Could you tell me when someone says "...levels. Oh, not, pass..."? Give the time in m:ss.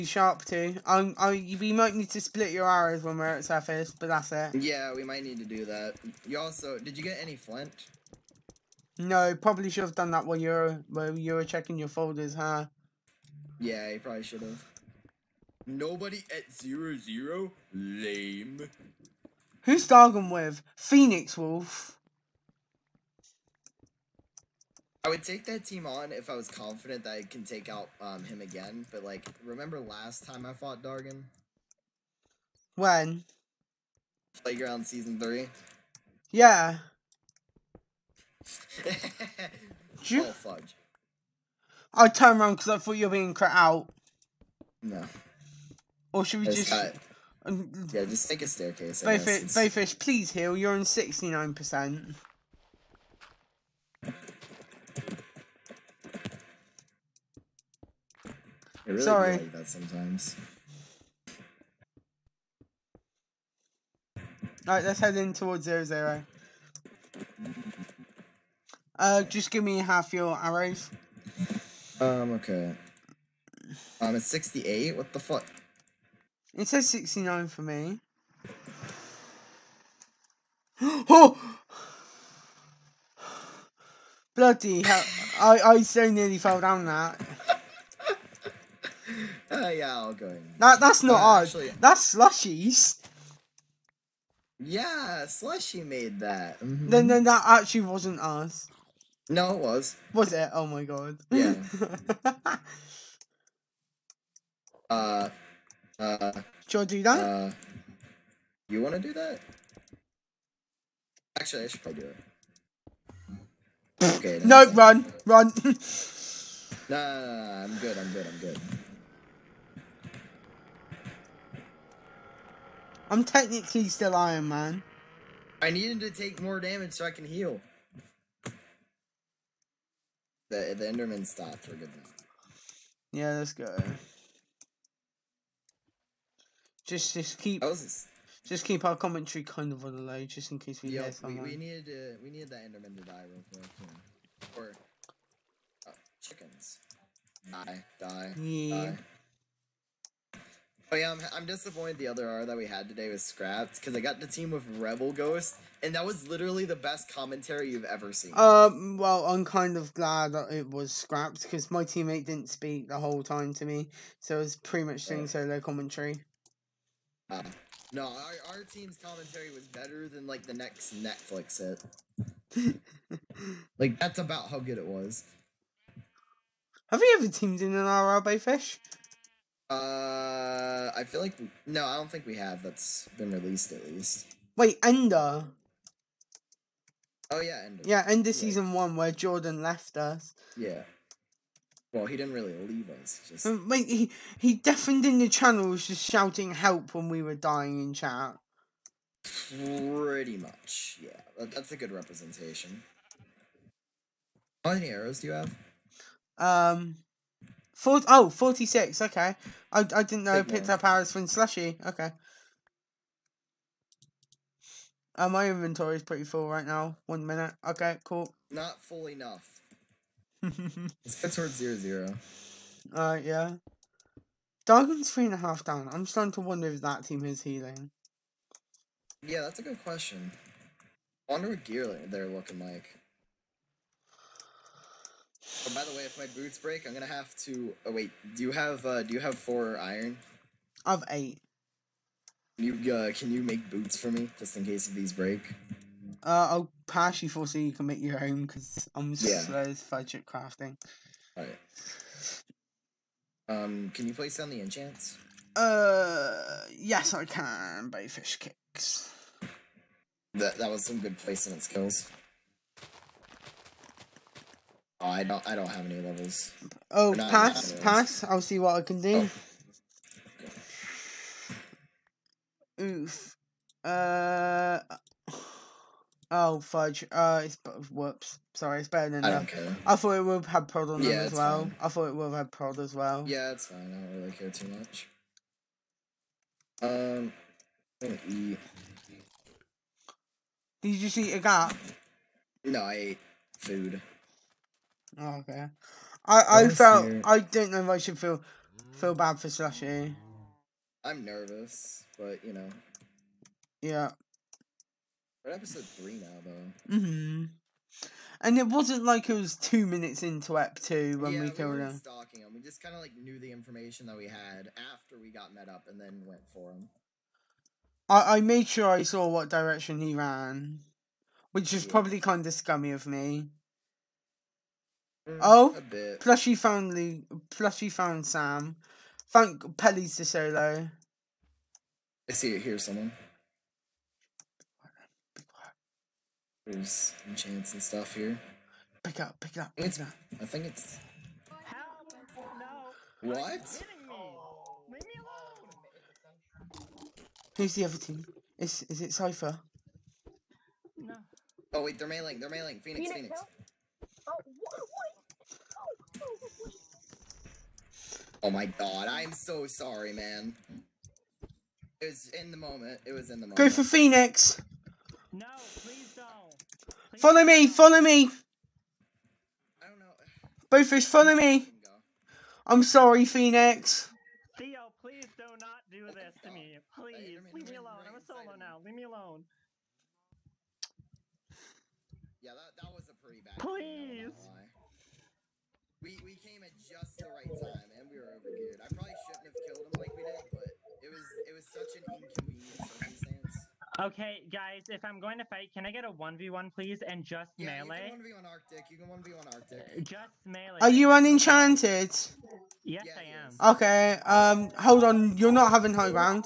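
4:25.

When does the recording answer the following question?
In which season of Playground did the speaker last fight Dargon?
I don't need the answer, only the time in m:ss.
0:34.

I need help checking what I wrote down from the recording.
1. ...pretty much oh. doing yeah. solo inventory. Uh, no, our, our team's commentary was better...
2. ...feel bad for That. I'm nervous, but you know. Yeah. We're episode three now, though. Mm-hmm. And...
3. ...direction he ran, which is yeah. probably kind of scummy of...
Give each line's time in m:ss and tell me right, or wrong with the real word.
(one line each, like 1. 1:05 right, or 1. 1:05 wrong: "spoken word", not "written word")
1. 2:44 wrong: "commentary", not "inventory"
2. 4:58 wrong: "Slushy", not "That"
3. 5:19 right.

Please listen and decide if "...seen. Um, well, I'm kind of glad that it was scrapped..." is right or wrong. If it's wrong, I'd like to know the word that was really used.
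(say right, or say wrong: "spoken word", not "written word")
right.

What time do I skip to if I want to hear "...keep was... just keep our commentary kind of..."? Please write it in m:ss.
2:17.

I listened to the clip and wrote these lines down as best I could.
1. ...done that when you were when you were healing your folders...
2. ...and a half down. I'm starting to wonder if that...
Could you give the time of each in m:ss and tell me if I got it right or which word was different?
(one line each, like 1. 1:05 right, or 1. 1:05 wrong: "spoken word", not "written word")
1. 0:09 wrong: "checking", not "healing"
2. 3:45 right.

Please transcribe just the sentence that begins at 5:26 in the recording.
plushy found Luke, plushy found Sam.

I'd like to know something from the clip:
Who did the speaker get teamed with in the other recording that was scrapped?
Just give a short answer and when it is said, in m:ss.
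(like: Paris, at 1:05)
Rebel Ghost, at 2:34.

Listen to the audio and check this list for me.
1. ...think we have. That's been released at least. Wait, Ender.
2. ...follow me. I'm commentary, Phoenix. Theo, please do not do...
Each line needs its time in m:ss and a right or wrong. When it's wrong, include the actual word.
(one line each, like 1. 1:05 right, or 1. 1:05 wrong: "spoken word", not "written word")
1. 3:02 right
2. 6:11 wrong: "sorry", not "commentary".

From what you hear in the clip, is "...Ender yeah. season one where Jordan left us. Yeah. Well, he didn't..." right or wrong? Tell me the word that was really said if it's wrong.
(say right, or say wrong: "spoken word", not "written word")
right.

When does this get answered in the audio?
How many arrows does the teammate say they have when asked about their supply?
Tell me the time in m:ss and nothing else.
3:28.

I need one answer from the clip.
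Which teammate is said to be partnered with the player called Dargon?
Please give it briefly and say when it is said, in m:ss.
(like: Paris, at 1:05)
Phoenix Wolf, at 0:20.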